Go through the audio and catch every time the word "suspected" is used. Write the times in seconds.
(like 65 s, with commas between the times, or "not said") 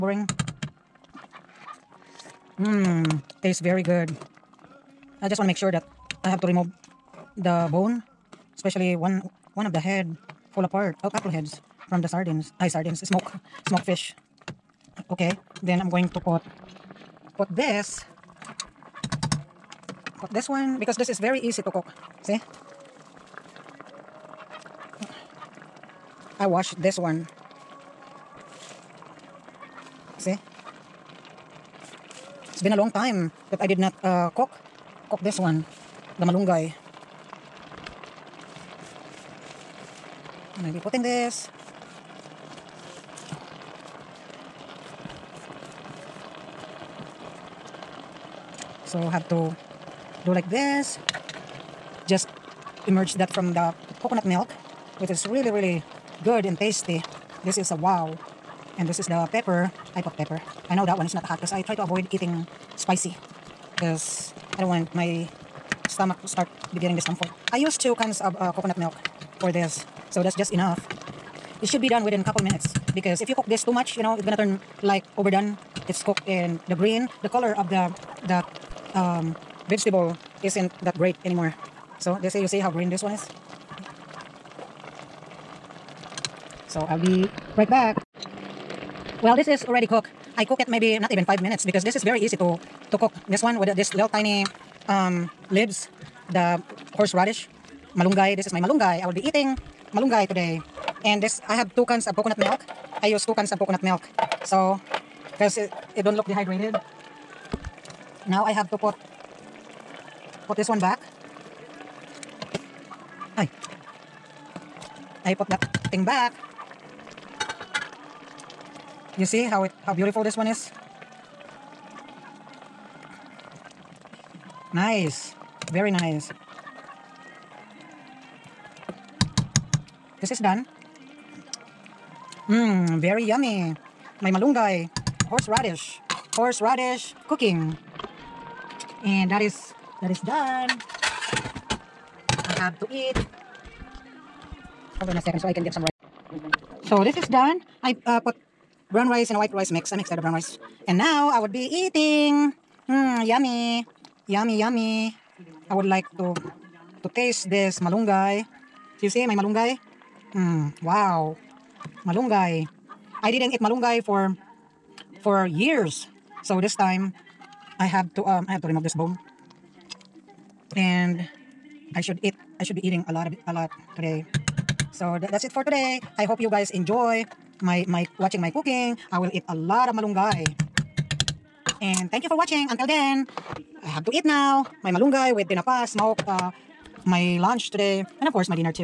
not said.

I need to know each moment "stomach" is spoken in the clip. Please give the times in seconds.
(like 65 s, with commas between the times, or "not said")
65 s.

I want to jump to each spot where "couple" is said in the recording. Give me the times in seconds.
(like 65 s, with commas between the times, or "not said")
11 s, 72 s.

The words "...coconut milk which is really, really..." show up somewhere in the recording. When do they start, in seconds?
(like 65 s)
54 s.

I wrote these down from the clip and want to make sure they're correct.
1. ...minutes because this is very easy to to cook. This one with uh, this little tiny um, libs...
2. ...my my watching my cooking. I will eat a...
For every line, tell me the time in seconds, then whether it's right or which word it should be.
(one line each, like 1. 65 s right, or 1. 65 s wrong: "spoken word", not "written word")
1. 91 s right
2. 177 s right.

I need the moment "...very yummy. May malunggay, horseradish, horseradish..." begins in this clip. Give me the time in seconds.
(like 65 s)
133 s.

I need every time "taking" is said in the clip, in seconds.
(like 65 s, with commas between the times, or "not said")
not said.